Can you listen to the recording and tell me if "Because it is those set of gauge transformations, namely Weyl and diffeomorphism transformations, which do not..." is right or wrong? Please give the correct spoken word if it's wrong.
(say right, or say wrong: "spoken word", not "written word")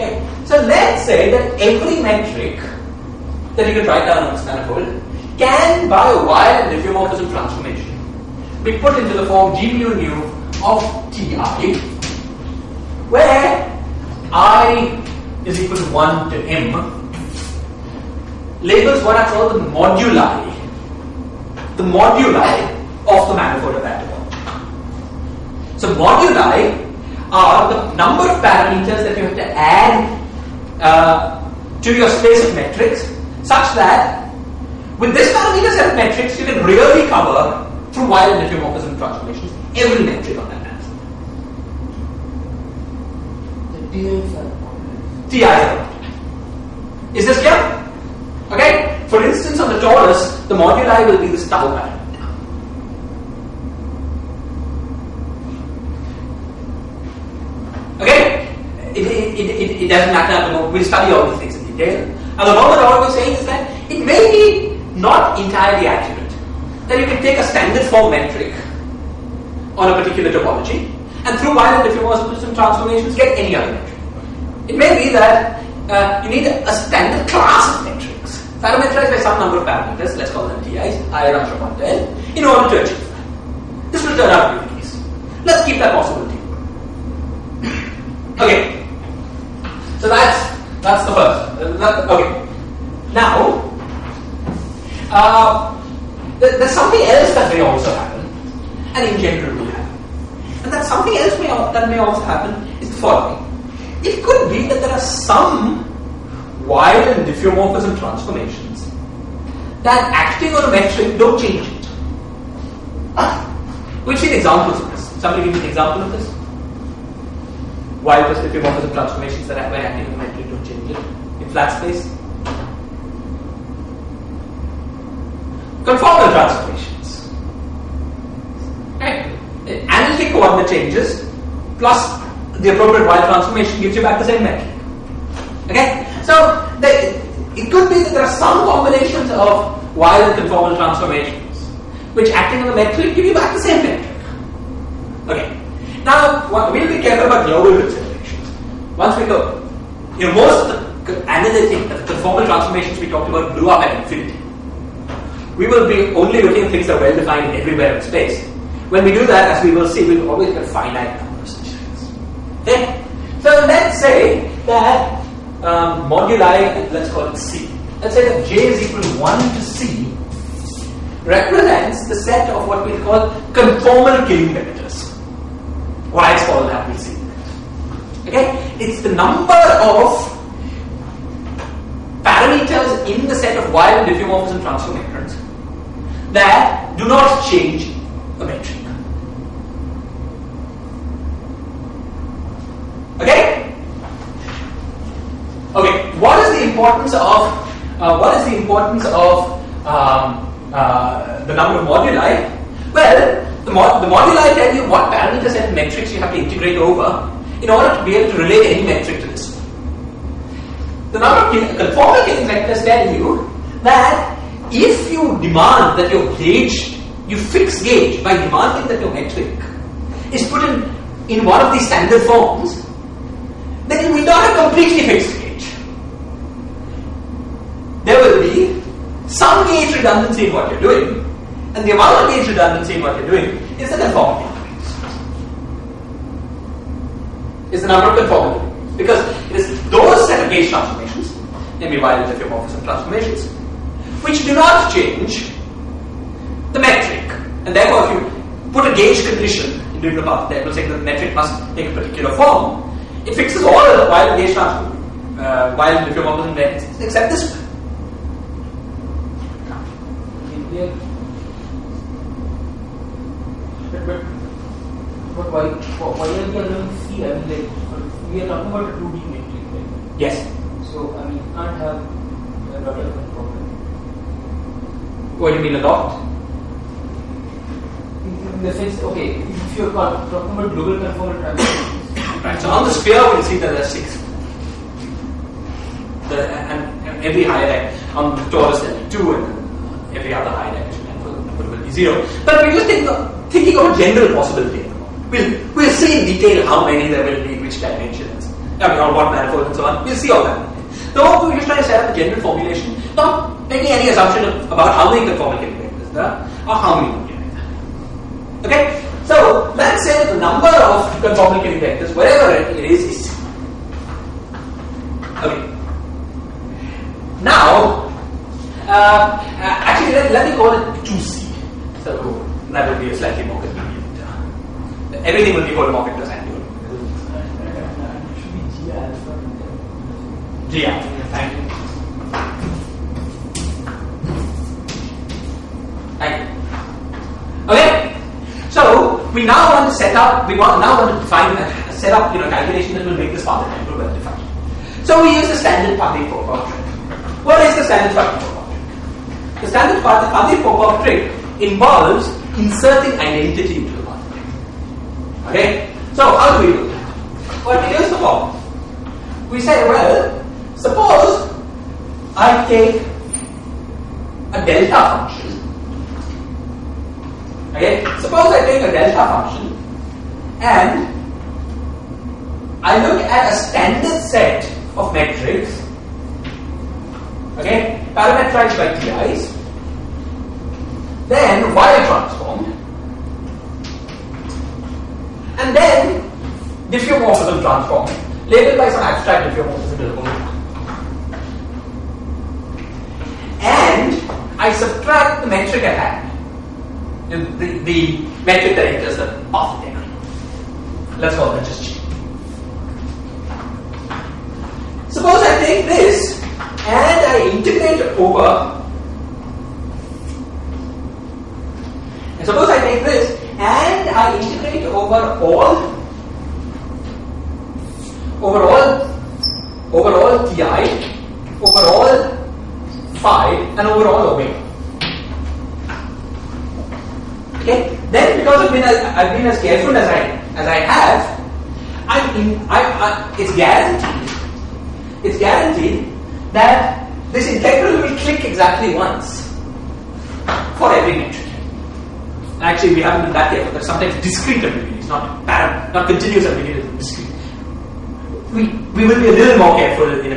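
right.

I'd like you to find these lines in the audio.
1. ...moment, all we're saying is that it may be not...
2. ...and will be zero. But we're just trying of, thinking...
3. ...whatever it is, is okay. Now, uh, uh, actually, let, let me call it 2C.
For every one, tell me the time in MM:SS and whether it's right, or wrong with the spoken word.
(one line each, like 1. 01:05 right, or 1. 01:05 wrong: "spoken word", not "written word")
1. 01:02 right
2. 04:50 wrong: "thinking", not "trying"
3. 05:12 right.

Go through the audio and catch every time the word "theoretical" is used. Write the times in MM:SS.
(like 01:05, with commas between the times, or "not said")
not said.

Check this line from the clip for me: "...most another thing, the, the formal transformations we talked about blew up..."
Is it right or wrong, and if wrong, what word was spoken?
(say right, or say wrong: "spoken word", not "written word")
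right.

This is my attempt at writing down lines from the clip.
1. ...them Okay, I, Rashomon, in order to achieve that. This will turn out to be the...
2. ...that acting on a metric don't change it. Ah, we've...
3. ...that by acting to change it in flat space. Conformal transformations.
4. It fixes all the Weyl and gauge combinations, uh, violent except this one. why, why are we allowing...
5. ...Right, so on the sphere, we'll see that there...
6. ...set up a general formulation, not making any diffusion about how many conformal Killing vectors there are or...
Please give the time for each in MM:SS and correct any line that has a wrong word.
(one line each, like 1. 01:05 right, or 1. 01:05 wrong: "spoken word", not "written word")
1. 01:20 wrong: "TIs", not "Okay"
2. 01:49 right
3. 01:59 right
4. 04:13 wrong: "transformations", not "combinations"
5. 04:42 right
6. 05:01 wrong: "assumption", not "diffusion".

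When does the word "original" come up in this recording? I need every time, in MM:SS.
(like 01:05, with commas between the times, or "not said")
not said.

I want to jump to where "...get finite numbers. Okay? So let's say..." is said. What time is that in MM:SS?
02:40.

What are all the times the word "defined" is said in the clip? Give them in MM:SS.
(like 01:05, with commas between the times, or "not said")
02:37, 05:44.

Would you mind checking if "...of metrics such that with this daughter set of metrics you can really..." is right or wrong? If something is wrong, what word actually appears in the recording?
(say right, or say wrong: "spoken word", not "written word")
wrong: "parameter", not "daughter".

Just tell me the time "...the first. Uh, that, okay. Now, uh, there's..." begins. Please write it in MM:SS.
01:31.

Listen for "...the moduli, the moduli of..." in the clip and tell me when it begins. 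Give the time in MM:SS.
00:19.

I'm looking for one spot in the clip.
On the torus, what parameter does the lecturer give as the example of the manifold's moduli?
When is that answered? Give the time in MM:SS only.
00:51.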